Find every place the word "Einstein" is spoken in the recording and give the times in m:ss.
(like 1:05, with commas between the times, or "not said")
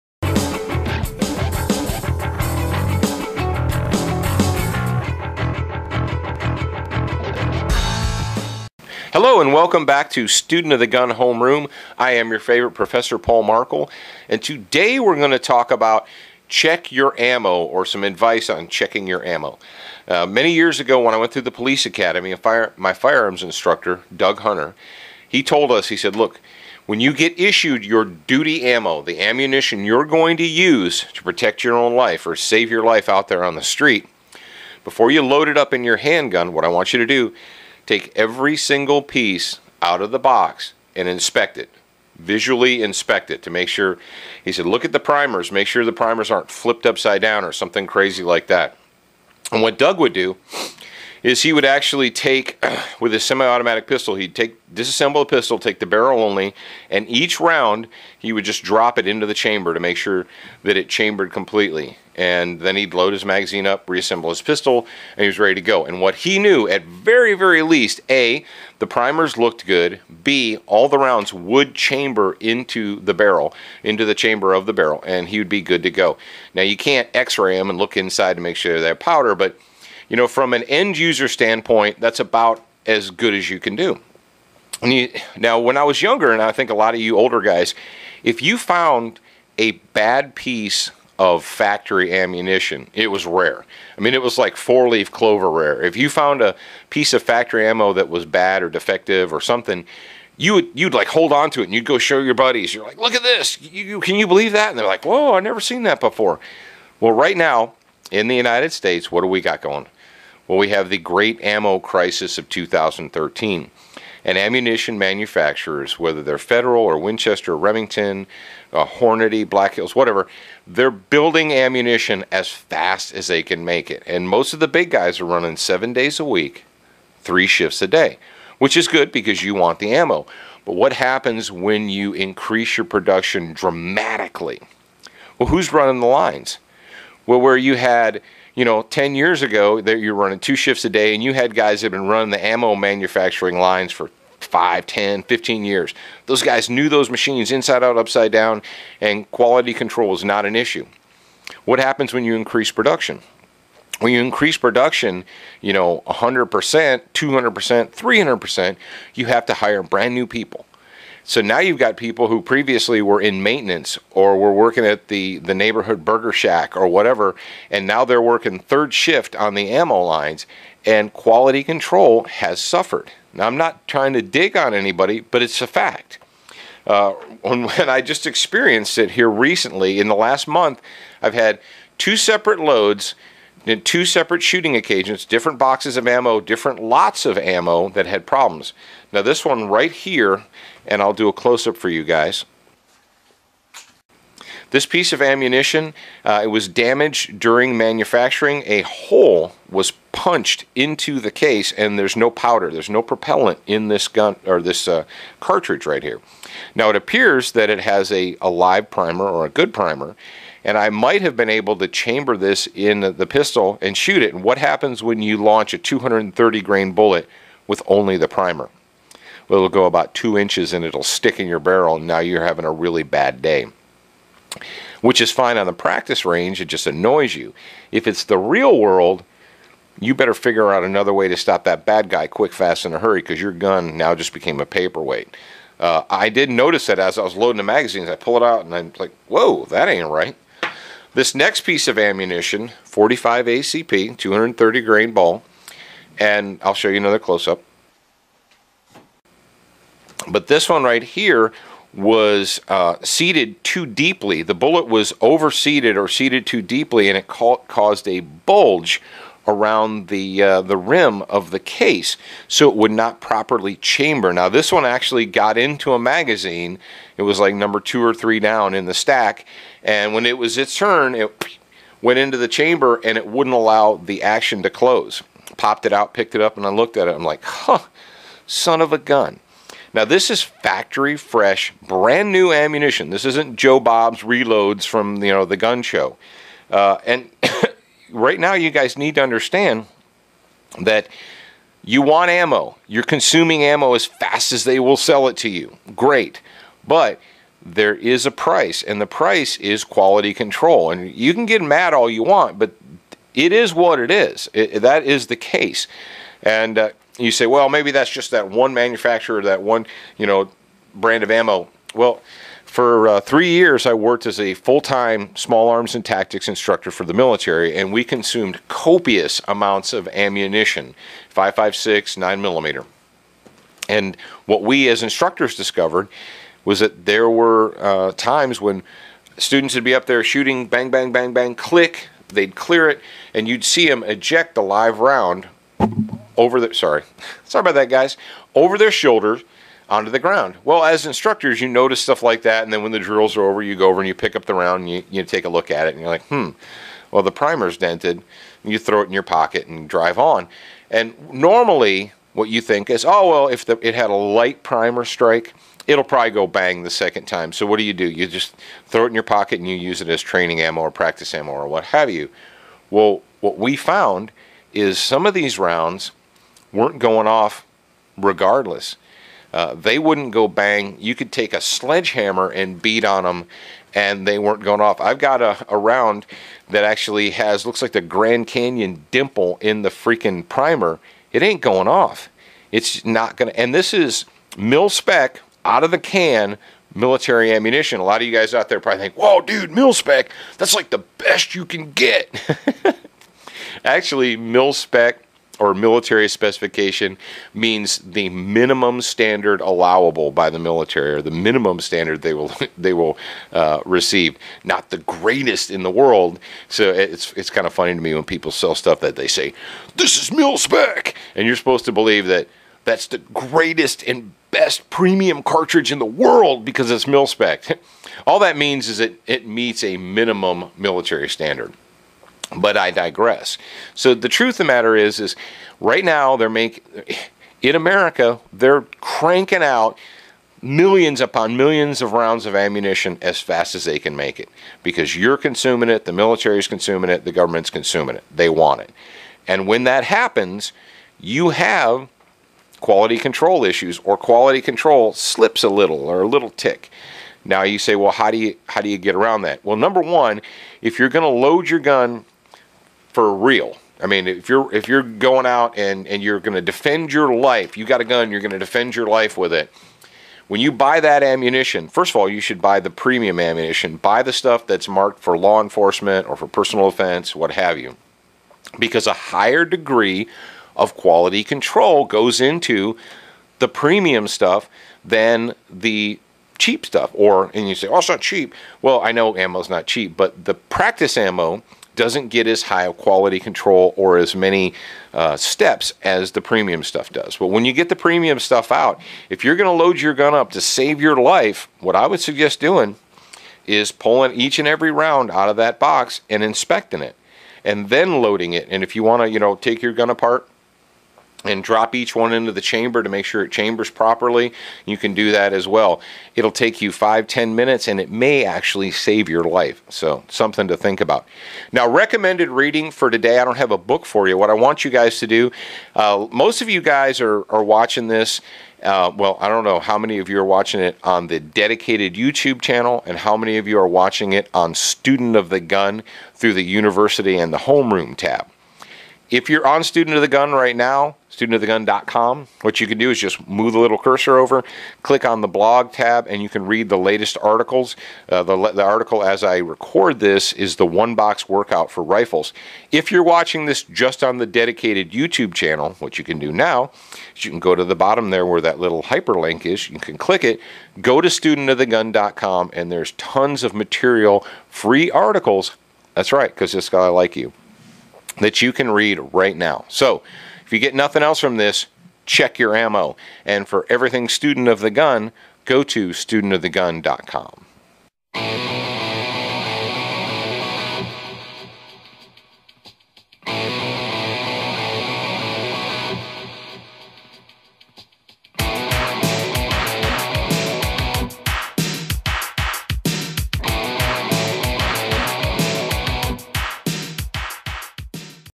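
not said.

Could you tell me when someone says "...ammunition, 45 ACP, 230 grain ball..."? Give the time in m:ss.
4:01.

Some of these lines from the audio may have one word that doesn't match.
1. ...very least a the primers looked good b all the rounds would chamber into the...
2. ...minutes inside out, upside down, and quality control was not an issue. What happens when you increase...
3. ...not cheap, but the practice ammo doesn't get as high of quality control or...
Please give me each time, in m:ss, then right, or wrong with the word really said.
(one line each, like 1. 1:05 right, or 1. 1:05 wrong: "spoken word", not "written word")
1. 1:07 right
2. 2:27 wrong: "machines", not "minutes"
3. 7:59 right.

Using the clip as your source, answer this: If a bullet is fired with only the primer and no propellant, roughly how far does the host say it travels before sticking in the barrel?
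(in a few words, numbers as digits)
2 inches.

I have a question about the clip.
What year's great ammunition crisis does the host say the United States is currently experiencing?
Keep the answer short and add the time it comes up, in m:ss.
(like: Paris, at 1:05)
2013, at 1:52.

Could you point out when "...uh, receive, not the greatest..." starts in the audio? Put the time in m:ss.
6:43.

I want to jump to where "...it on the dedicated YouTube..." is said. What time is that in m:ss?
8:40.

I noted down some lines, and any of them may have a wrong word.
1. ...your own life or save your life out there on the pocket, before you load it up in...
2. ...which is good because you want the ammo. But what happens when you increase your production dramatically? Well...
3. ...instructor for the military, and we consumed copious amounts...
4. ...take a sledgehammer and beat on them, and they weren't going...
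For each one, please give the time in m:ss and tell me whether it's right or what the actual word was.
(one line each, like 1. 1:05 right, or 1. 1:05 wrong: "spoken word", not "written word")
1. 0:31 wrong: "street", not "pocket"
2. 2:08 right
3. 5:16 right
4. 6:11 right.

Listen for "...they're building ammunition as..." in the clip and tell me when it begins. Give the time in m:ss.
2:00.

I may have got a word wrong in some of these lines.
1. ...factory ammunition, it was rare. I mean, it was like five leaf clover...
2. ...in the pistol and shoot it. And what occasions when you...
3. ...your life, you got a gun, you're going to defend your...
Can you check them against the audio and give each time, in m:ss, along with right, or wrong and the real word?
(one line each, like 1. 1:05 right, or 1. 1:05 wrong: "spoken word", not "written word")
1. 1:31 wrong: "four", not "five"
2. 3:32 wrong: "happens", not "occasions"
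3. 7:37 right.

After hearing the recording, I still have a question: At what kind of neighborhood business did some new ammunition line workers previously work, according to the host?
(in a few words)
burger shack.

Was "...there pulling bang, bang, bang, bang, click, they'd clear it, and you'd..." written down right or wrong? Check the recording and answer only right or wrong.
wrong.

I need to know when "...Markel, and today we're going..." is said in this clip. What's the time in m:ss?
0:13.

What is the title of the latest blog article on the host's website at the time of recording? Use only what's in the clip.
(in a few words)
one box workout for rifles.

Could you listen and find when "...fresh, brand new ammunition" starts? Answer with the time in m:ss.
4:41.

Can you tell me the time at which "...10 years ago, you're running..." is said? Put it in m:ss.
2:18.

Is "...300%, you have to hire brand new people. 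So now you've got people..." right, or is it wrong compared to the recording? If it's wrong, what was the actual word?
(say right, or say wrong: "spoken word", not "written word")
right.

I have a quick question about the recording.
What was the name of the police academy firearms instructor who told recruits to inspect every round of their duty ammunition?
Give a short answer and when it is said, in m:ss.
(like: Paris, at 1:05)
Doug Hunter, at 0:24.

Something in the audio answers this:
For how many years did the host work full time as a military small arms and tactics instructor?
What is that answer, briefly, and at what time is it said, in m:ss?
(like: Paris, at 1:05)
3 years, at 5:13.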